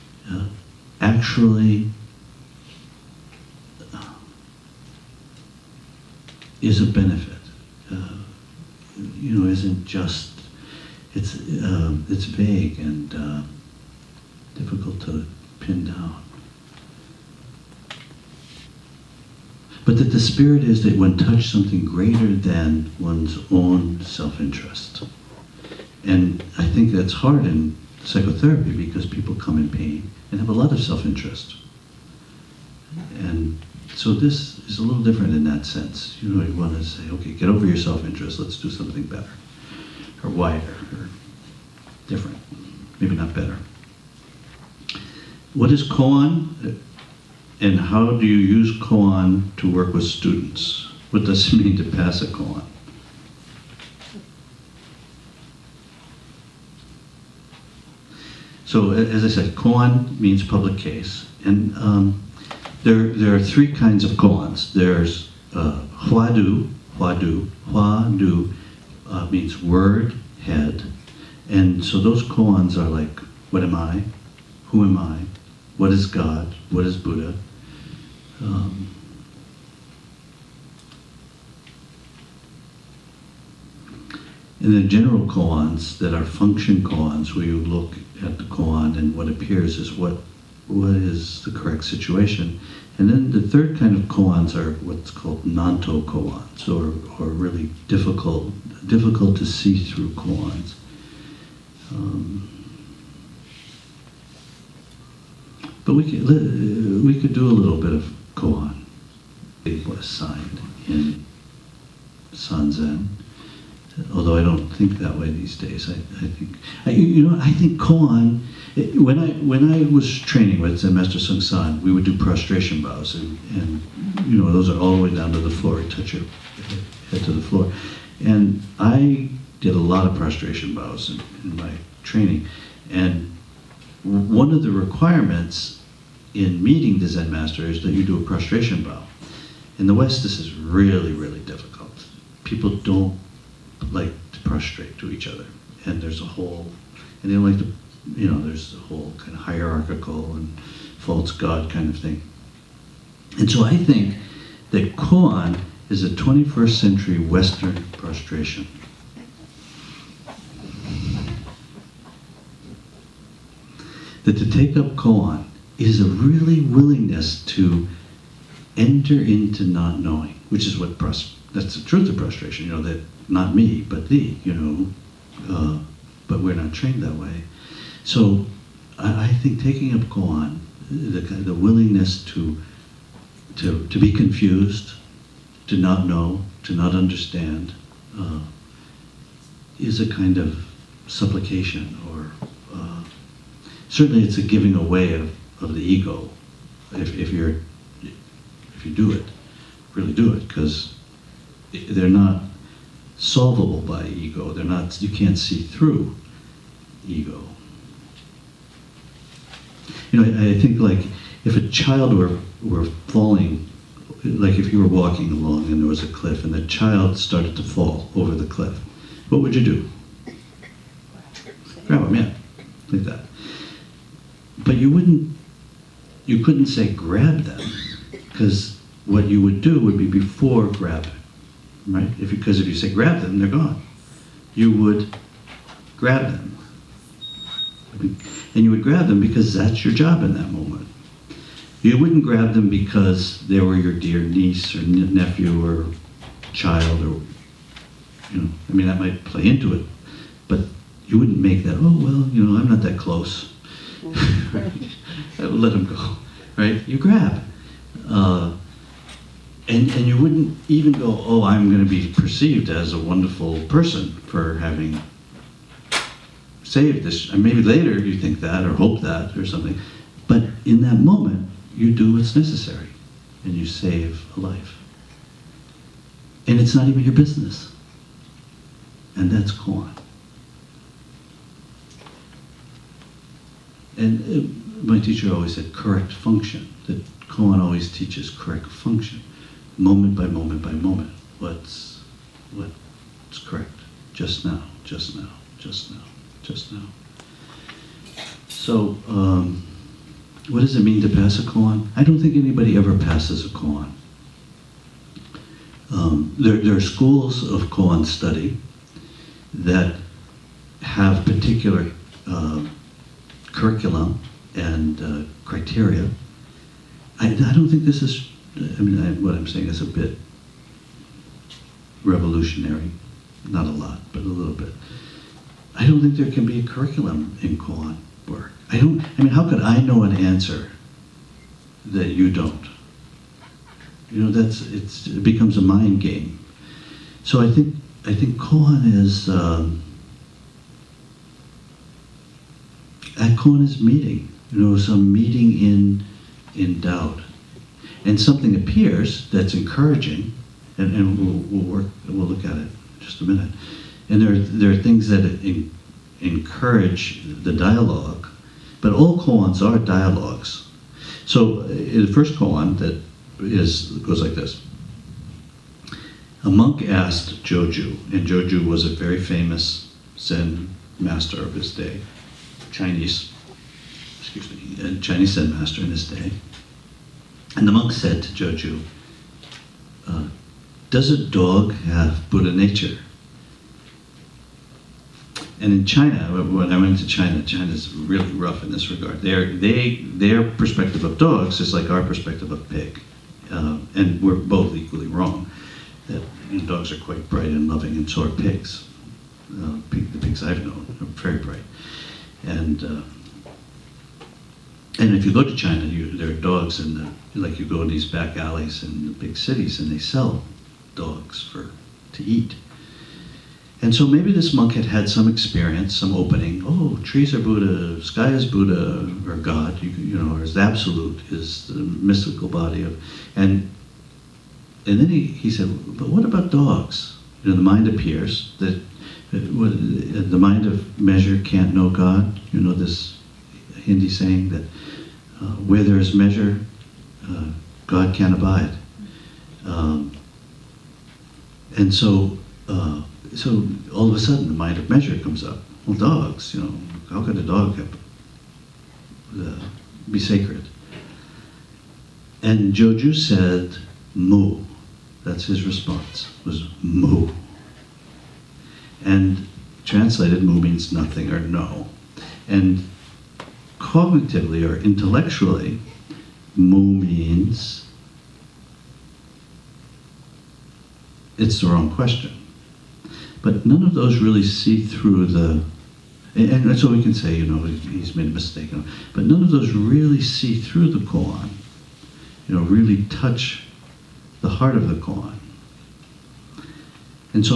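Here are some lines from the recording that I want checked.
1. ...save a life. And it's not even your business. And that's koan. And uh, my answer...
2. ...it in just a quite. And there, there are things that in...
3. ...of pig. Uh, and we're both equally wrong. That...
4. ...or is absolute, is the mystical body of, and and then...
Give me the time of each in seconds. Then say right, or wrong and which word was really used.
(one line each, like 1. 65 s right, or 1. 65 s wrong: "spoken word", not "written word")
1. 273 s wrong: "teacher", not "answer"
2. 352 s wrong: "minute", not "quite"
3. 392 s right
4. 420 s right.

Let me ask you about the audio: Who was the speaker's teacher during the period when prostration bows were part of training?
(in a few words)
Master Seung Sahn.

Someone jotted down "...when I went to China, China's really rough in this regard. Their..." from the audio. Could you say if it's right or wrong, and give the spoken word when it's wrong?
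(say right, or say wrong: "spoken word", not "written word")
right.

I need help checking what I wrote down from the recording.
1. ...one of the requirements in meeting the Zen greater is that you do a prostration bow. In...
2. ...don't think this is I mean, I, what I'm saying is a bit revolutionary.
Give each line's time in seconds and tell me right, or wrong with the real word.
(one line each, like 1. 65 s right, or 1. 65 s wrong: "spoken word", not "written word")
1. 134 s wrong: "master", not "greater"
2. 317 s right.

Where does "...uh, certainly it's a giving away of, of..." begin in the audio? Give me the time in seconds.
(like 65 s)
192 s.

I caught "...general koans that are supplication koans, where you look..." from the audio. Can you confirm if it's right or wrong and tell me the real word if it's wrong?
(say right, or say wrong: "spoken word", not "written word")
wrong: "function", not "supplication".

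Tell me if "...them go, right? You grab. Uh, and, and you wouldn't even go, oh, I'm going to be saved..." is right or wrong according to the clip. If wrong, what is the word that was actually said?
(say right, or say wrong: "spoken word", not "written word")
wrong: "perceived", not "saved".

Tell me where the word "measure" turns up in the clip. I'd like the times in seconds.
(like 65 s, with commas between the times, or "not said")
430 s, 436 s, 444 s.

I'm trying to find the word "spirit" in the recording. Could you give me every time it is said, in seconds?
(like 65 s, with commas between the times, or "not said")
20 s.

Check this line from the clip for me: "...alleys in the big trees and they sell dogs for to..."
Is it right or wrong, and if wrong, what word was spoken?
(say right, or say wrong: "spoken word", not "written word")
wrong: "cities", not "trees".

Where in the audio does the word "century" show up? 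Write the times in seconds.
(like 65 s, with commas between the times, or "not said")
156 s.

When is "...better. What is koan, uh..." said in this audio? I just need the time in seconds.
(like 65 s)
43 s.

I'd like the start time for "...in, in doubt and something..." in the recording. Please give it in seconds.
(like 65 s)
345 s.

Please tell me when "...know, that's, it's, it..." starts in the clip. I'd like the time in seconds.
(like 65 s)
334 s.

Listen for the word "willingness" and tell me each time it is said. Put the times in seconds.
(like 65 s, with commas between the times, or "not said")
166 s, 181 s.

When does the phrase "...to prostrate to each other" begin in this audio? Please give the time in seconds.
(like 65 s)
144 s.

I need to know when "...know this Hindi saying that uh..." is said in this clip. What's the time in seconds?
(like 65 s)
432 s.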